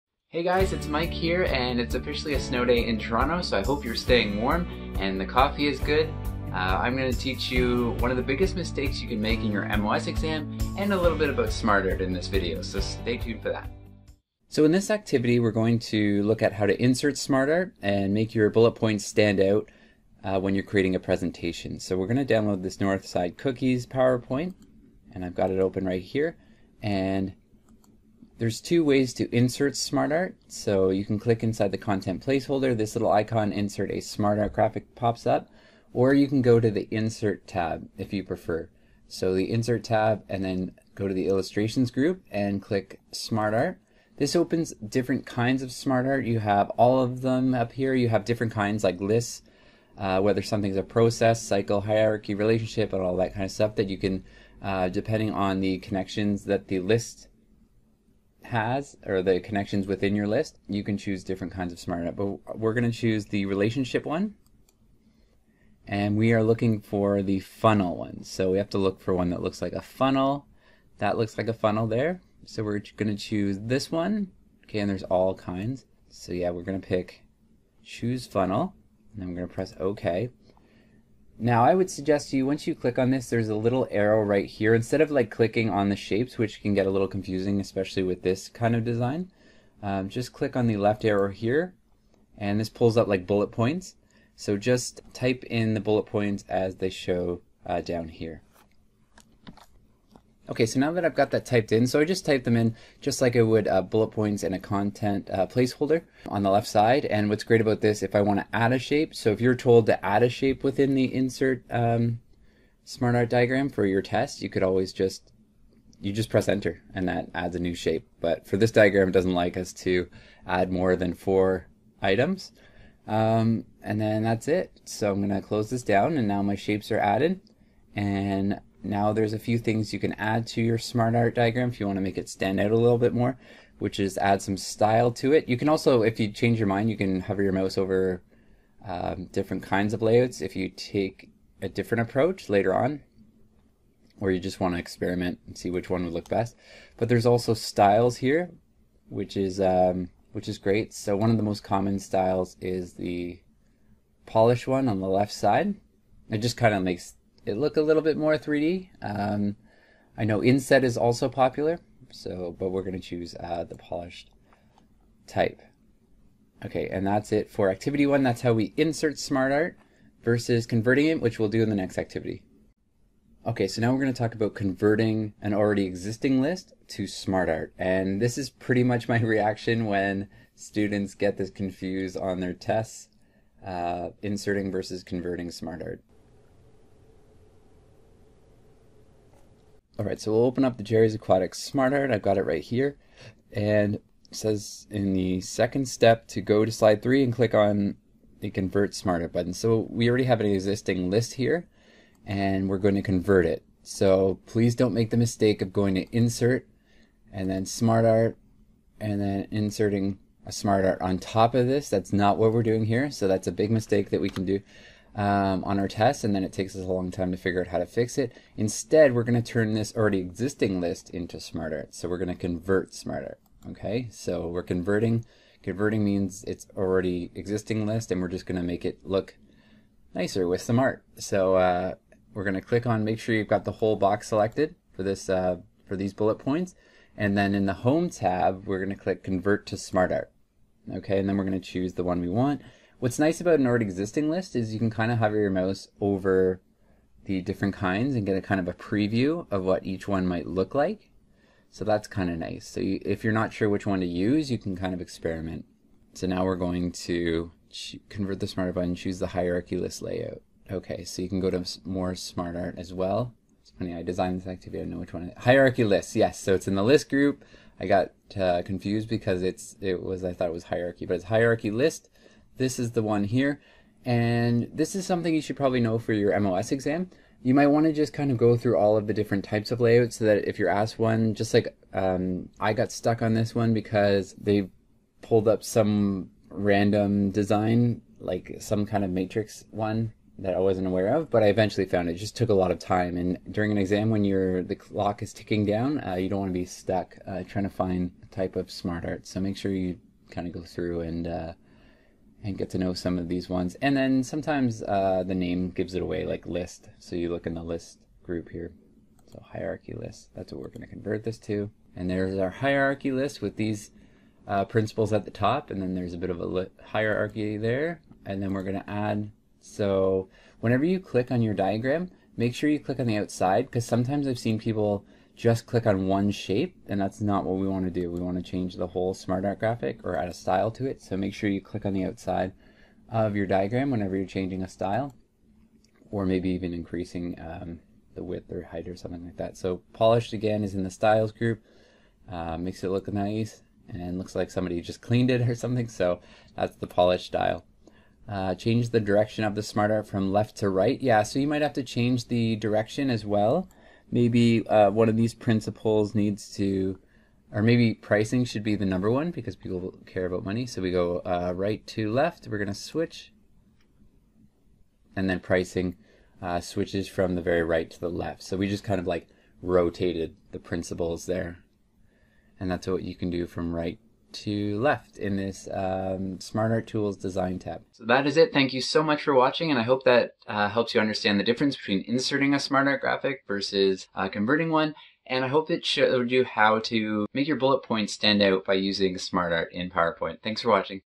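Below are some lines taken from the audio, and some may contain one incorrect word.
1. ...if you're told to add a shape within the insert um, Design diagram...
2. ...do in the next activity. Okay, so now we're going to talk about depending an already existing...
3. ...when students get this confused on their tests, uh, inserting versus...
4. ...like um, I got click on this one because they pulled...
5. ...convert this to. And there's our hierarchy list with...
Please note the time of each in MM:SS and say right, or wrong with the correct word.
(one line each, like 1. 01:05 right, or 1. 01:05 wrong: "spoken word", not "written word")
1. 01:49 wrong: "SmartArt", not "Design"
2. 02:51 wrong: "converting", not "depending"
3. 02:59 right
4. 04:41 wrong: "stuck", not "click"
5. 05:10 right.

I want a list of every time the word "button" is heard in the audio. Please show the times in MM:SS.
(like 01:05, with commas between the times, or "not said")
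03:19, 04:18.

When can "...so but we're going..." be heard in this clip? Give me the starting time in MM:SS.
02:42.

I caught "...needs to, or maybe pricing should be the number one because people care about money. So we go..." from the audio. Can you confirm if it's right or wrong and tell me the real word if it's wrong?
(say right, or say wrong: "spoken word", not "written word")
right.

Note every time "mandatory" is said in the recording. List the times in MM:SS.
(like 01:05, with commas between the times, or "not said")
not said.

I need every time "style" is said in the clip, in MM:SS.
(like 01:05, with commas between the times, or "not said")
02:14, 02:27, 02:31, 05:30, 05:34, 05:40, 05:47.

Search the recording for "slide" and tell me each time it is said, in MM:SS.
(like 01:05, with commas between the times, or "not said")
03:16.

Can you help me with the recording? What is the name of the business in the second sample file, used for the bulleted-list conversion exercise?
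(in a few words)
Jerry's Aquatics.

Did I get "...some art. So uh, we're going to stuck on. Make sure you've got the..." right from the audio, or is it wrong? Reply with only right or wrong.
wrong.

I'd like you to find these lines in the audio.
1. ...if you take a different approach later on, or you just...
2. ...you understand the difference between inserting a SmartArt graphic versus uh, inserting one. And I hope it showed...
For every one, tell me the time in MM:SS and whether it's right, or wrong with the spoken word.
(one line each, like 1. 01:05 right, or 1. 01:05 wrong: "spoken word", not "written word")
1. 02:20 right
2. 06:20 wrong: "converting", not "inserting".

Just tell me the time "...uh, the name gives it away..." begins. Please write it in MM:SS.
05:04.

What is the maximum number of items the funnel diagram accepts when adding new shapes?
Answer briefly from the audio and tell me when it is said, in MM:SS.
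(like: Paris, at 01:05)
4, at 02:01.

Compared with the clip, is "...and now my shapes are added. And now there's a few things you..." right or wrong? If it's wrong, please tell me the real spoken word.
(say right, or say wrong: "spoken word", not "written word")
right.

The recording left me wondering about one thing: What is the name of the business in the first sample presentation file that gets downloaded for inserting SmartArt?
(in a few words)
Northside Cookies.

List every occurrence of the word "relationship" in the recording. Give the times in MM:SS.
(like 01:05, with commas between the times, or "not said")
00:52, 01:03.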